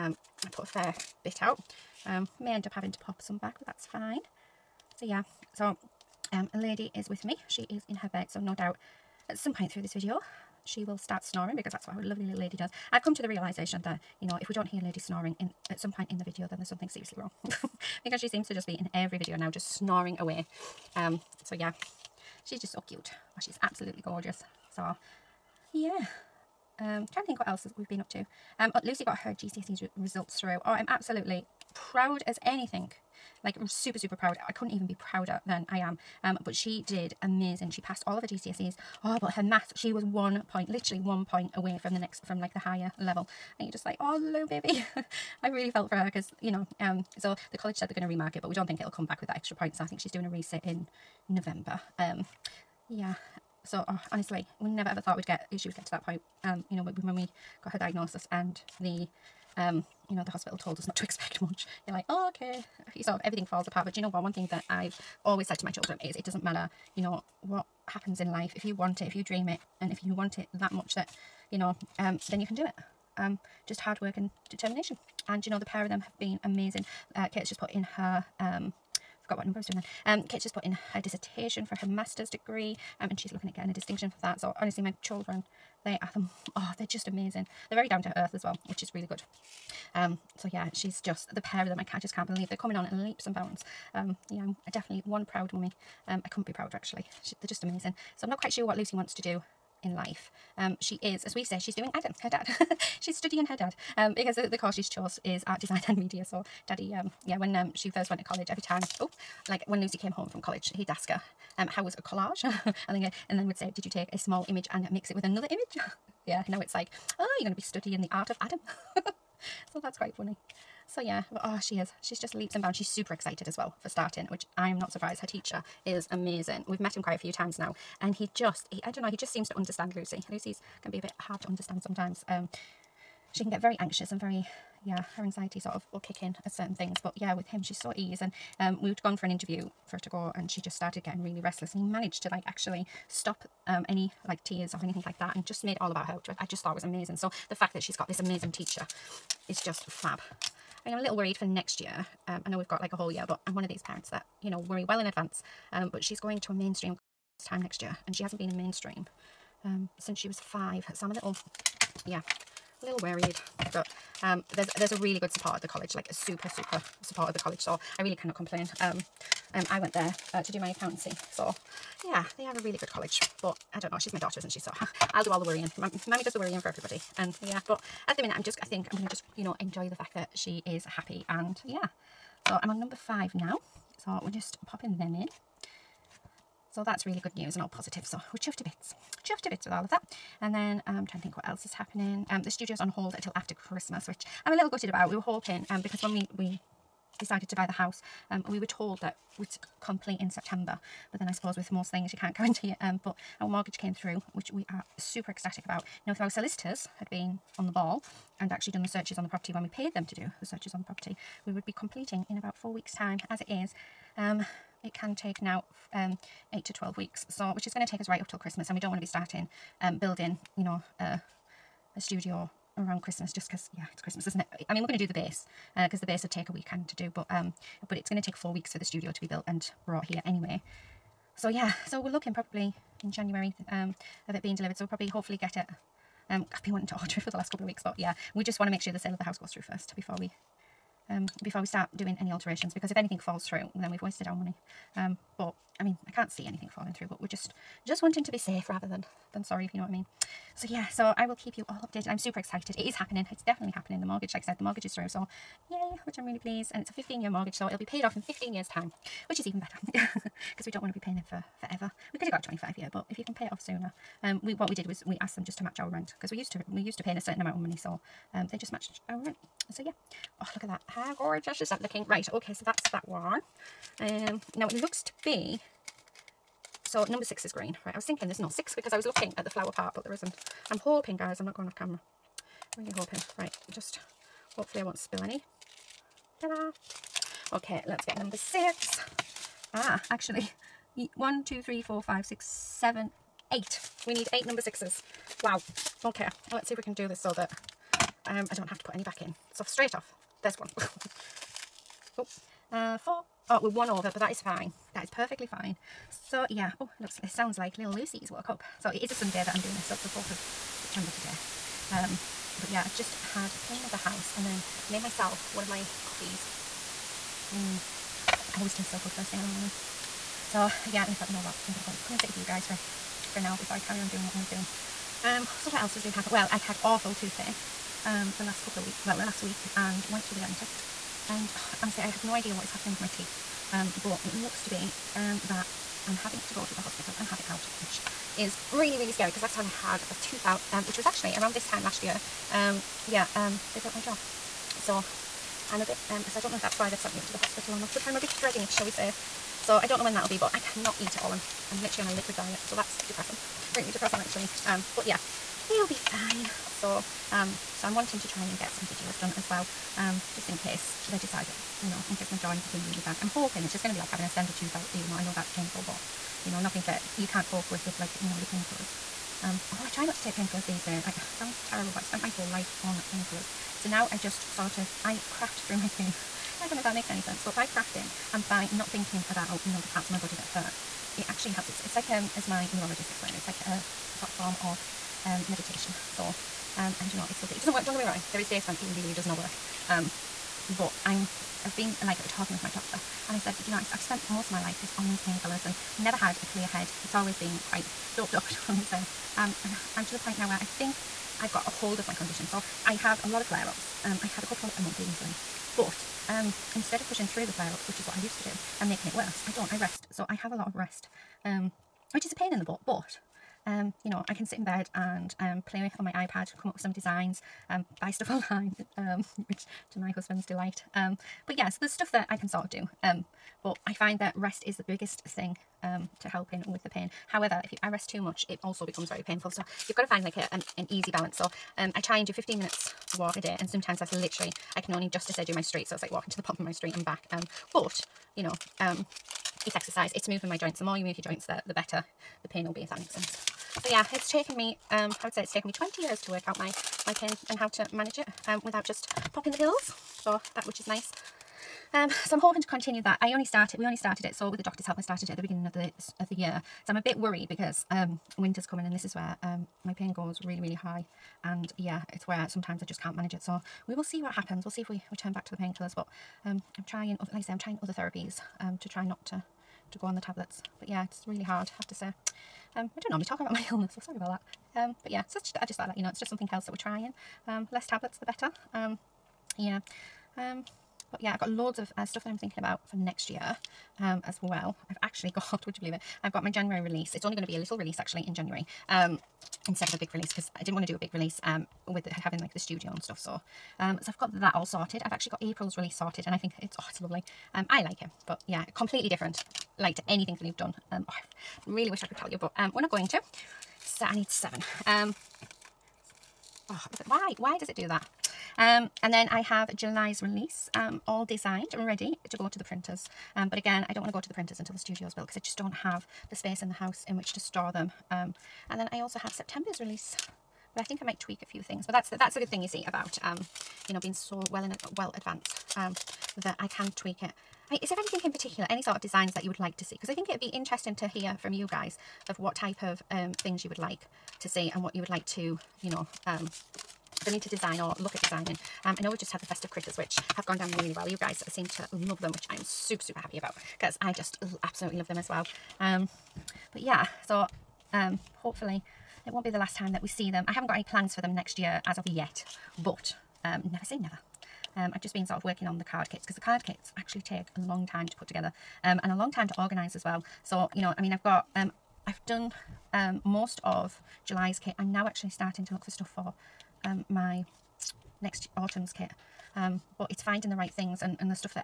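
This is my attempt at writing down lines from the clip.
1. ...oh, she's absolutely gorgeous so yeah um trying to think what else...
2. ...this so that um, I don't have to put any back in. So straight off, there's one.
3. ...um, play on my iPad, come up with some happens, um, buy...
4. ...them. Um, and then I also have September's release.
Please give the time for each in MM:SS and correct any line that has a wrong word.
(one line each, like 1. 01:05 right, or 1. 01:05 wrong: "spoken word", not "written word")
1. 00:23 right
2. 04:57 right
3. 06:55 wrong: "designs", not "happens"
4. 08:37 right.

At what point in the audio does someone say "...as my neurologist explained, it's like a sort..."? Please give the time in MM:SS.
06:22.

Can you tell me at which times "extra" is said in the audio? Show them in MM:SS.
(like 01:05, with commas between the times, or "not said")
00:49.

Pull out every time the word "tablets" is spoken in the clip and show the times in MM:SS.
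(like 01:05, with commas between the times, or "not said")
07:50, 07:57.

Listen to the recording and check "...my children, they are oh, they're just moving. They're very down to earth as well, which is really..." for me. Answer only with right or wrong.
wrong.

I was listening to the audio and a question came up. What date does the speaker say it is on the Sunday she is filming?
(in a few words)
4th of September.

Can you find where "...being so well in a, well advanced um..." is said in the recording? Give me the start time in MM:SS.
08:43.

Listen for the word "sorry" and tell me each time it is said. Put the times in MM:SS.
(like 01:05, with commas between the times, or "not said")
04:09, 07:54.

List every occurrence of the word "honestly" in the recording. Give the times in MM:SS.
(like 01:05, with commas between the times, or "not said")
00:54, 01:24, 05:31.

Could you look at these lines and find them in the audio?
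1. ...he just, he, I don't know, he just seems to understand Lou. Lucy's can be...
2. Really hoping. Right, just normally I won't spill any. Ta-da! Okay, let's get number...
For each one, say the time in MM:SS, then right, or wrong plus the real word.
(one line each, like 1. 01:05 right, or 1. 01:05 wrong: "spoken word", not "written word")
1. 02:08 wrong: "Lucy", not "Lou"
2. 04:42 wrong: "hopefully", not "normally".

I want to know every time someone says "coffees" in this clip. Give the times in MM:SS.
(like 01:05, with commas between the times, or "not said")
05:16.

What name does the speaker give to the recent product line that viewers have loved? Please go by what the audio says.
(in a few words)
Festive critters.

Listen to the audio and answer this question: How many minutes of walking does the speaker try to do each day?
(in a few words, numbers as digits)
15 minutes.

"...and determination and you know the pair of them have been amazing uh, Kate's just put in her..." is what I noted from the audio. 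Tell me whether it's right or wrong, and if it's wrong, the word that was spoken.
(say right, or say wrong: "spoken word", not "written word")
right.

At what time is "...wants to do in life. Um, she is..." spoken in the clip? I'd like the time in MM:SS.
01:38.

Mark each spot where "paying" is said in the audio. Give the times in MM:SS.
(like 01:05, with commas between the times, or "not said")
04:21, 04:27.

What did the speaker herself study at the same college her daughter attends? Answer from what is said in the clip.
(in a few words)
Accountancy.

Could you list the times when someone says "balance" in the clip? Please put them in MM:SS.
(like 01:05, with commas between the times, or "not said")
07:11.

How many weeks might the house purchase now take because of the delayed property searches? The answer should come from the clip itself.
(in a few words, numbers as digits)
8 to 12 weeks.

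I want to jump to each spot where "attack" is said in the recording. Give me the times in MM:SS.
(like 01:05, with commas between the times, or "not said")
not said.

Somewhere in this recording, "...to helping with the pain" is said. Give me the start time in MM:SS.
07:06.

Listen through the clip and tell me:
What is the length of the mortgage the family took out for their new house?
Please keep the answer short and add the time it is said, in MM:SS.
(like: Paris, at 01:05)
15 years, at 04:16.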